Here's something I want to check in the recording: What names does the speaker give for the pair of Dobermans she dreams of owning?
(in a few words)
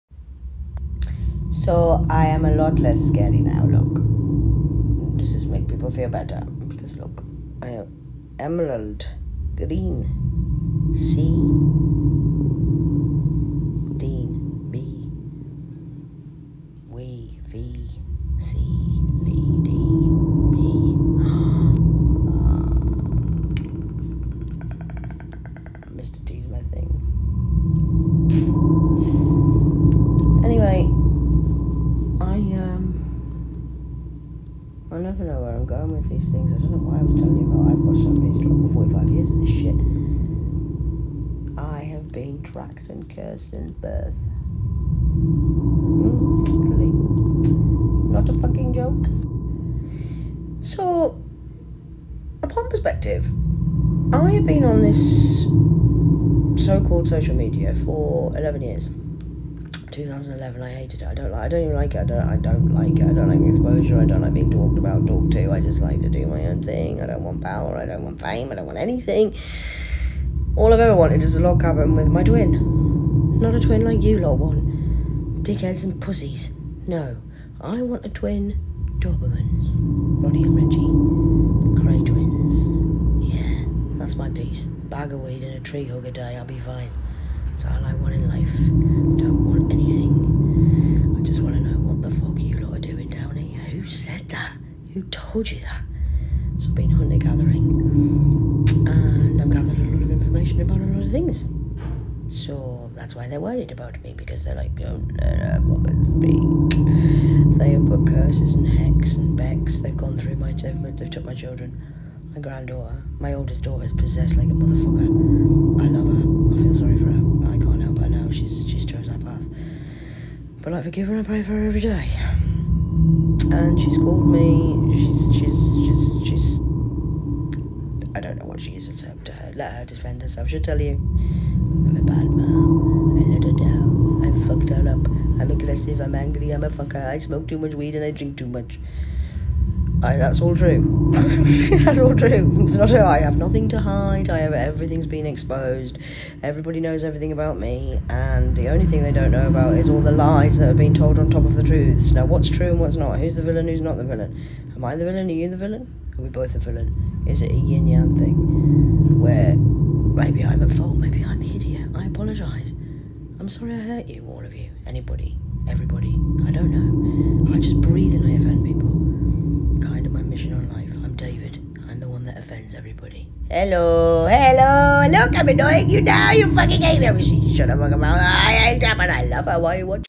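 Ronnie and Reggie.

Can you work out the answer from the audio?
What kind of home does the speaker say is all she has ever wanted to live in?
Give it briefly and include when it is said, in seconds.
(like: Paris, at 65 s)
Log cabin, at 71 s.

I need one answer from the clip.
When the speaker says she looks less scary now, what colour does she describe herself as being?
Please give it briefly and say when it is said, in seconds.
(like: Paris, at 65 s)
Emerald green, at 8 s.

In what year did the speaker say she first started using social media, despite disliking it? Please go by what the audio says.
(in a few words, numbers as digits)
2011.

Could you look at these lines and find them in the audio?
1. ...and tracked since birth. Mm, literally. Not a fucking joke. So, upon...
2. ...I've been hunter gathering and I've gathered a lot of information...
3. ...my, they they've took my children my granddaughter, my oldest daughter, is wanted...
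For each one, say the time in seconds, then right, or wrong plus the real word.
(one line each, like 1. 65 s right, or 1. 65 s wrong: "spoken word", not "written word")
1. 42 s wrong: "cursed", not "tracked"
2. 96 s right
3. 110 s wrong: "possessed", not "wanted".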